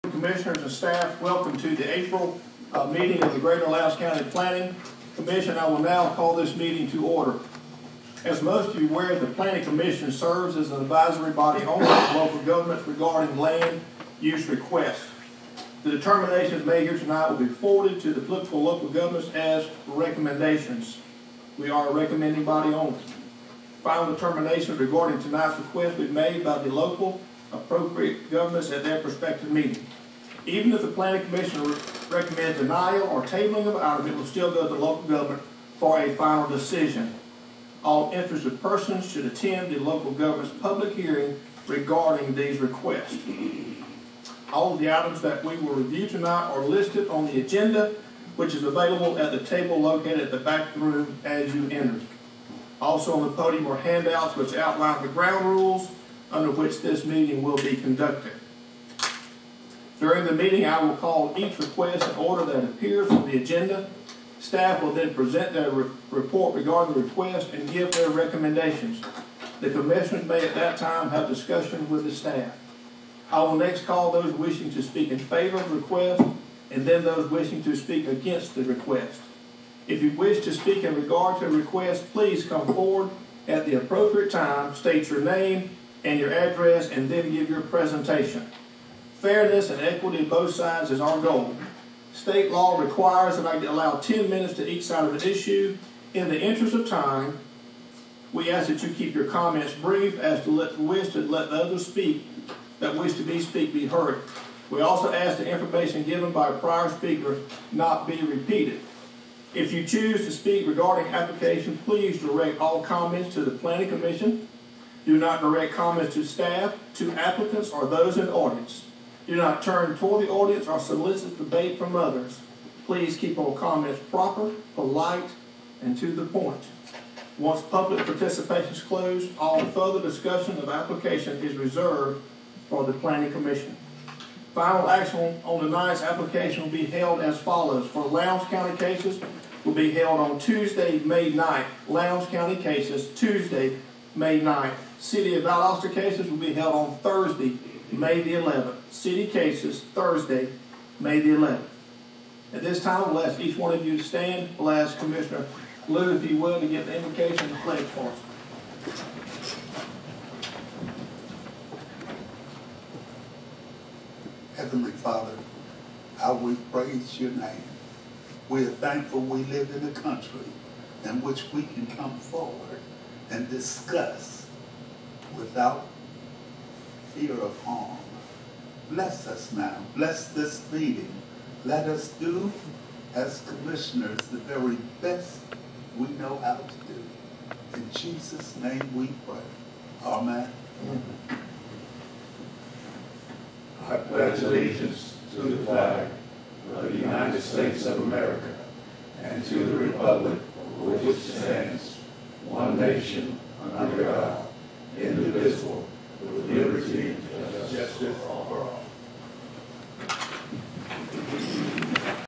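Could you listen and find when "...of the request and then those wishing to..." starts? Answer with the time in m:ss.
1:15.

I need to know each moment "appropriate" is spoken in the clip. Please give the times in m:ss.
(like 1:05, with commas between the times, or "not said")
0:27, 1:23.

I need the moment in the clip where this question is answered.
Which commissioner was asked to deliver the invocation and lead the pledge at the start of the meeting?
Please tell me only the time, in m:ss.
2:34.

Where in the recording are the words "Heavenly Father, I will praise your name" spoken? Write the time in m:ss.
2:44.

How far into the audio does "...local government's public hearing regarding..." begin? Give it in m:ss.
0:39.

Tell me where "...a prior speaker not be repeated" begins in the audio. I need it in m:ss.
1:46.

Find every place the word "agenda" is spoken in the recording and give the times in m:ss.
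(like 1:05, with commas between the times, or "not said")
0:47, 1:03.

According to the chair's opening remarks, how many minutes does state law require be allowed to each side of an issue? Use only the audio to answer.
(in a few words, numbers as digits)
10.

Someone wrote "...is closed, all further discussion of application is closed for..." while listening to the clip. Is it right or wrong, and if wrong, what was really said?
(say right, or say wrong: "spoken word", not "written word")
wrong: "reserved", not "closed".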